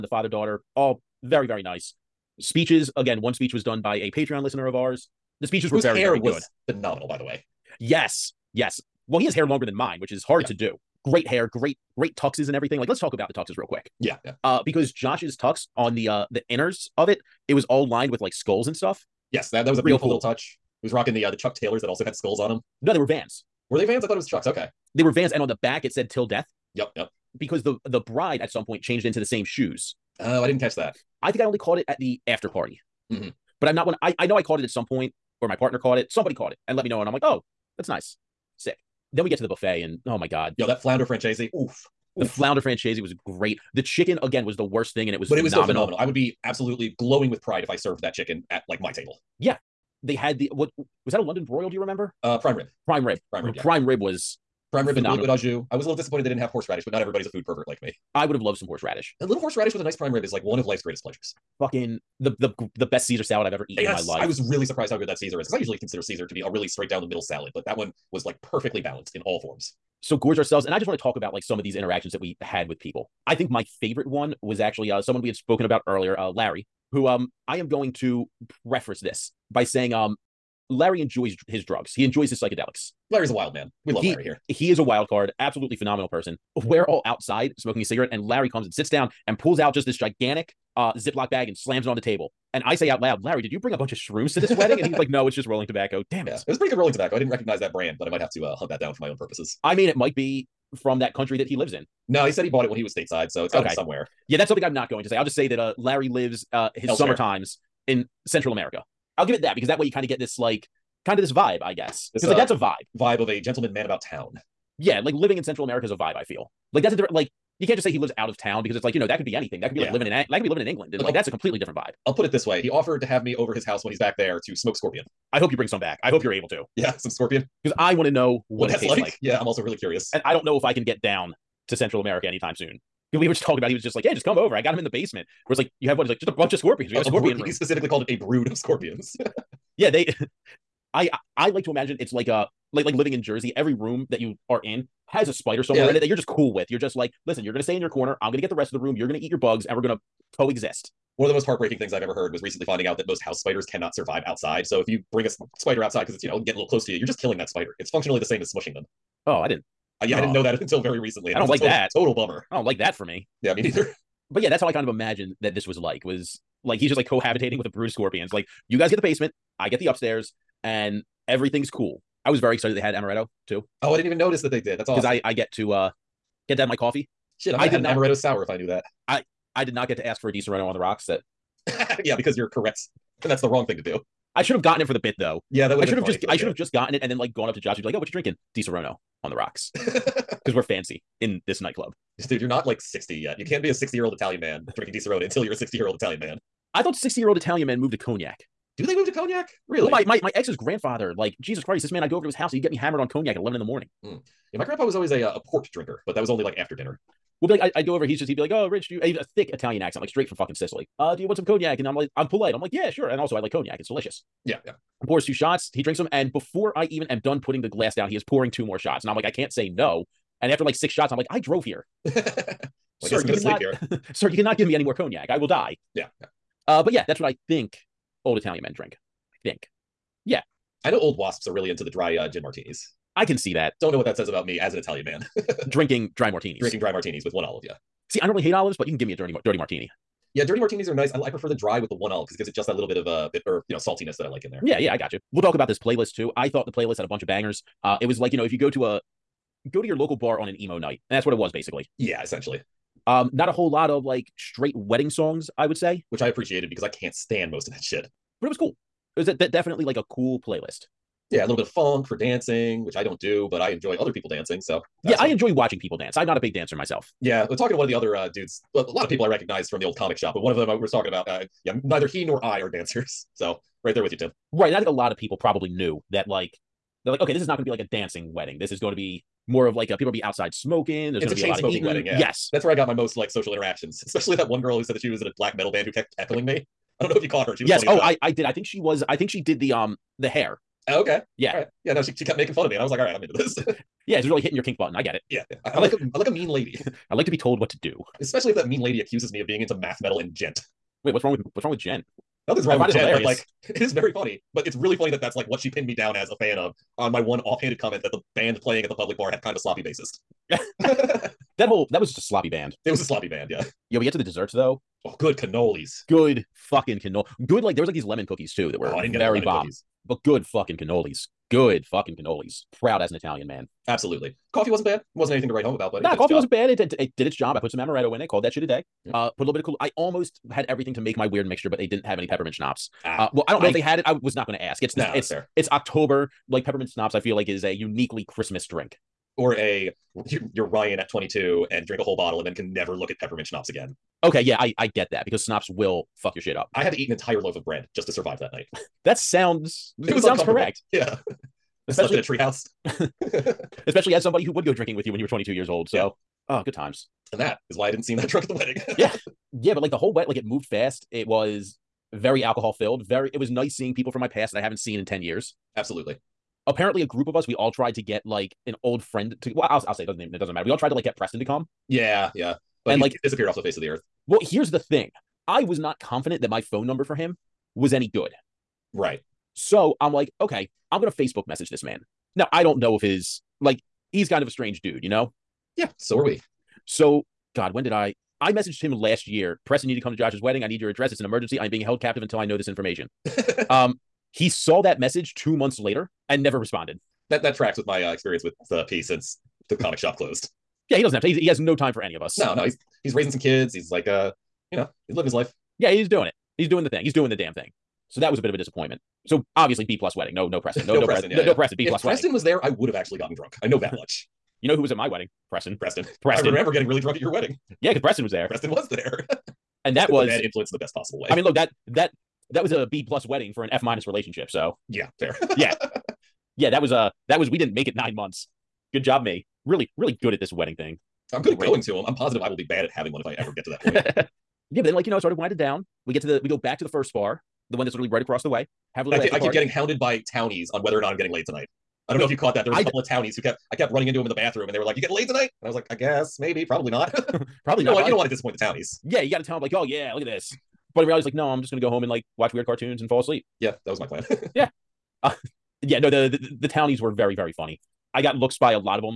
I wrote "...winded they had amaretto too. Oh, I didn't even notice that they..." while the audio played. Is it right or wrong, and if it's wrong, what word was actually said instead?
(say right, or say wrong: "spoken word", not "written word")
wrong: "excited", not "winded".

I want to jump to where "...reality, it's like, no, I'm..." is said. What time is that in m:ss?
7:31.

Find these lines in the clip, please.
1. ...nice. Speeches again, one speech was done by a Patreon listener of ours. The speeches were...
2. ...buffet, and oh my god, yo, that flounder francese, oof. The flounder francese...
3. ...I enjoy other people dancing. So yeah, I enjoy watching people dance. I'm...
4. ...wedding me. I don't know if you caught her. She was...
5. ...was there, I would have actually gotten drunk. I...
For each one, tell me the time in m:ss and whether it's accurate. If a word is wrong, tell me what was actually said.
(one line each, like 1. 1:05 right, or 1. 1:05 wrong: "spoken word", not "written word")
1. 0:01 right
2. 0:39 right
3. 4:23 right
4. 4:46 wrong: "heckling", not "wedding"
5. 6:52 right.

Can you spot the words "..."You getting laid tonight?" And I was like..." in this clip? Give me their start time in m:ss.
7:24.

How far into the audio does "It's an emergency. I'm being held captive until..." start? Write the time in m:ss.
6:31.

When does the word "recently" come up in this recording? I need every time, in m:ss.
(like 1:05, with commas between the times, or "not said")
2:32, 2:40.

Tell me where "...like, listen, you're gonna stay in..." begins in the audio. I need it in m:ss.
2:26.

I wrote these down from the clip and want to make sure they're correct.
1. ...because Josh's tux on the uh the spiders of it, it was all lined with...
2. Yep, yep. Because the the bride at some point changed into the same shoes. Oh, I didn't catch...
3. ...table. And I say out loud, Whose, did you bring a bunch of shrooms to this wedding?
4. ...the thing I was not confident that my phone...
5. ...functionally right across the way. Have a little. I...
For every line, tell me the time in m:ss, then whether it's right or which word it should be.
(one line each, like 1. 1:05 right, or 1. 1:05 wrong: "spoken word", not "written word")
1. 0:14 wrong: "inners", not "spiders"
2. 0:26 right
3. 1:32 wrong: "Larry", not "Whose"
4. 6:14 right
5. 7:17 wrong: "literally", not "functionally".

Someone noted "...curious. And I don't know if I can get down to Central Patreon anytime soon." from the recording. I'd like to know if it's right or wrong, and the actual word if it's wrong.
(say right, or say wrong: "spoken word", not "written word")
wrong: "America", not "Patreon".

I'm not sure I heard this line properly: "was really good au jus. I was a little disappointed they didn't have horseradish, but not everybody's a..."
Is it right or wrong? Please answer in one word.
right.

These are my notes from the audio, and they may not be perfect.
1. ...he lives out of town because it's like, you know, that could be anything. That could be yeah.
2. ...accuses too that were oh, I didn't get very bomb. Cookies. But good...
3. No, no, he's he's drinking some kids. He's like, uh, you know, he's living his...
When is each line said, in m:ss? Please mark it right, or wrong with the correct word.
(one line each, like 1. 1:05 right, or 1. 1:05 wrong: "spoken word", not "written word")
1. 1:57 right
2. 5:18 wrong: "cookies", not "accuses"
3. 6:42 wrong: "raising", not "drinking".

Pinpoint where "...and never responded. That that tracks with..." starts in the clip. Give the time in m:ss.
6:36.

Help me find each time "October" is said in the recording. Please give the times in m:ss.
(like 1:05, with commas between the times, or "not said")
5:35.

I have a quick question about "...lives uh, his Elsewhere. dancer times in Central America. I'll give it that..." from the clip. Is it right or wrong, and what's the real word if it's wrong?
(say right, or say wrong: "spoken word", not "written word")
wrong: "summer", not "dancer".